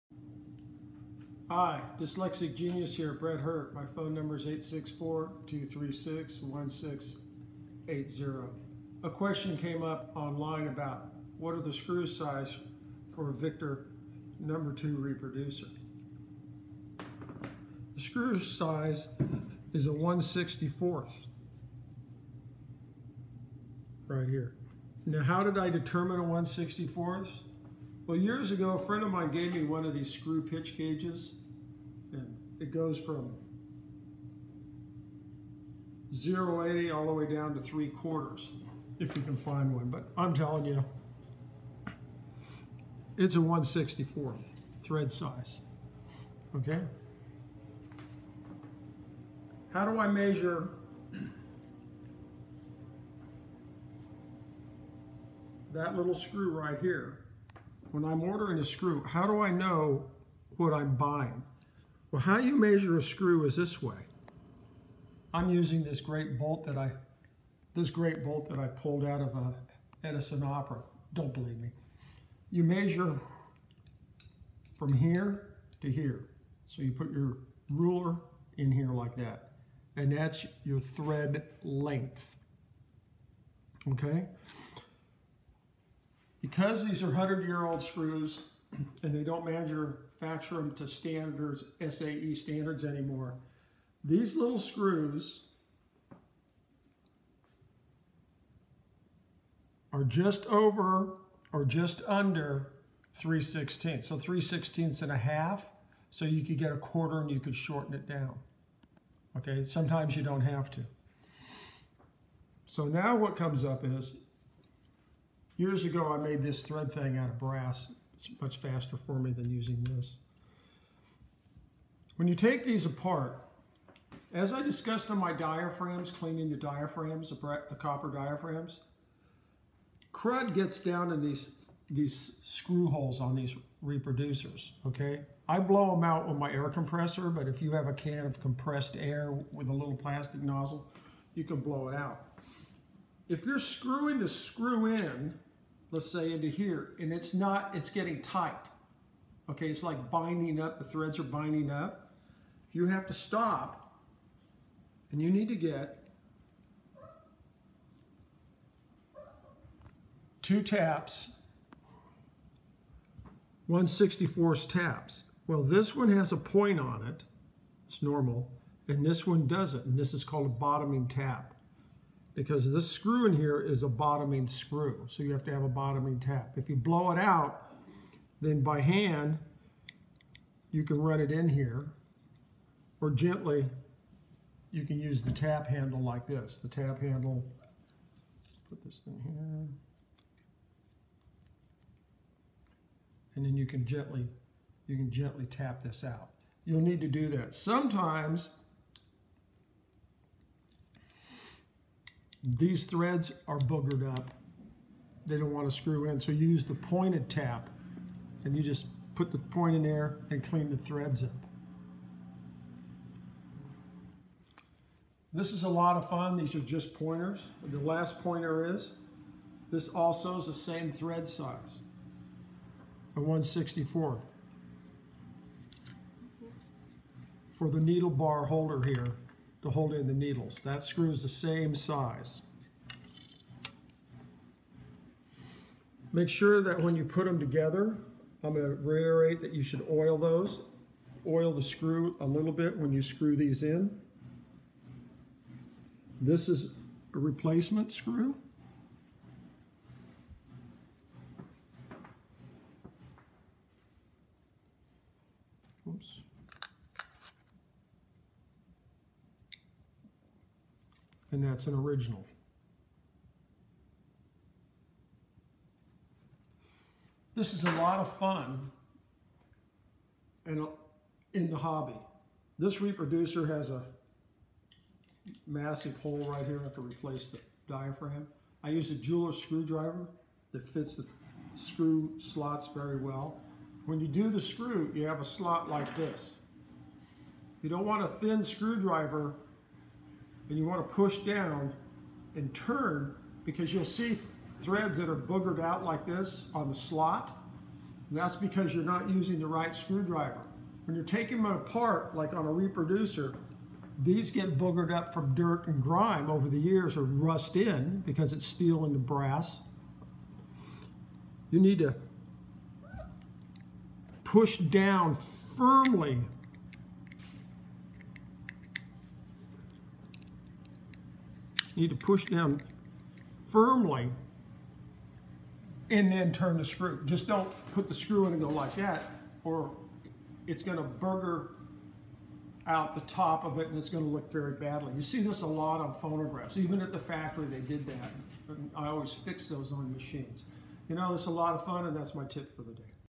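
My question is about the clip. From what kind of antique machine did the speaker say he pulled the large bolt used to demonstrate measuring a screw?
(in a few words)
Edison Opera.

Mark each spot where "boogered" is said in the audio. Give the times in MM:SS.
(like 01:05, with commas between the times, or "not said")
03:23, 04:55, 05:04.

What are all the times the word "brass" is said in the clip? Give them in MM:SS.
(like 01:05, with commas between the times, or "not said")
01:57, 05:08.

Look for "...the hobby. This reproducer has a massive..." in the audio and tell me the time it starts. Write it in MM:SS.
04:31.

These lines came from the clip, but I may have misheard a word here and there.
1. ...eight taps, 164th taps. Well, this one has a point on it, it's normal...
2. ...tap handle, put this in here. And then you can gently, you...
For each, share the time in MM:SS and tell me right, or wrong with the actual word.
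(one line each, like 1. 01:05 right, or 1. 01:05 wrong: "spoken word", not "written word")
1. 02:40 wrong: "two", not "eight"
2. 03:06 right.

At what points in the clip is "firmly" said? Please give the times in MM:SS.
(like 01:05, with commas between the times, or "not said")
05:15, 05:23.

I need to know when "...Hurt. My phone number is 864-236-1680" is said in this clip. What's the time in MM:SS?
00:03.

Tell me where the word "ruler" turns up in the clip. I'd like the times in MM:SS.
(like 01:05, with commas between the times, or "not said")
01:17.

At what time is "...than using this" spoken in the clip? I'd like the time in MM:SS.
01:59.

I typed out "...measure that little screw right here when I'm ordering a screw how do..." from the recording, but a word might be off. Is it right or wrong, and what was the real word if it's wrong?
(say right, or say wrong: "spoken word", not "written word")
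right.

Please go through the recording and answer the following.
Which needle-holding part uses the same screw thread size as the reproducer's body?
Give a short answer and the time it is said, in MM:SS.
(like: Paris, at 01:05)
needle bar holder, at 03:47.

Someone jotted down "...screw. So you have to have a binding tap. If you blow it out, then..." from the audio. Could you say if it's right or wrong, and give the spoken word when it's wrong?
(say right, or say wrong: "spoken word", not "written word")
wrong: "bottoming", not "binding".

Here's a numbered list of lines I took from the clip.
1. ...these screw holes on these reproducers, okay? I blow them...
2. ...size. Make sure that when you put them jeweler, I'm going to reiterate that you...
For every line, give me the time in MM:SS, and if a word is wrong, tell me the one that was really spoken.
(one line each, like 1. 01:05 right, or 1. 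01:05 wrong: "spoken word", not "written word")
1. 02:11 right
2. 03:51 wrong: "together", not "jeweler".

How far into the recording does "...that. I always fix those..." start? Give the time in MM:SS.
05:37.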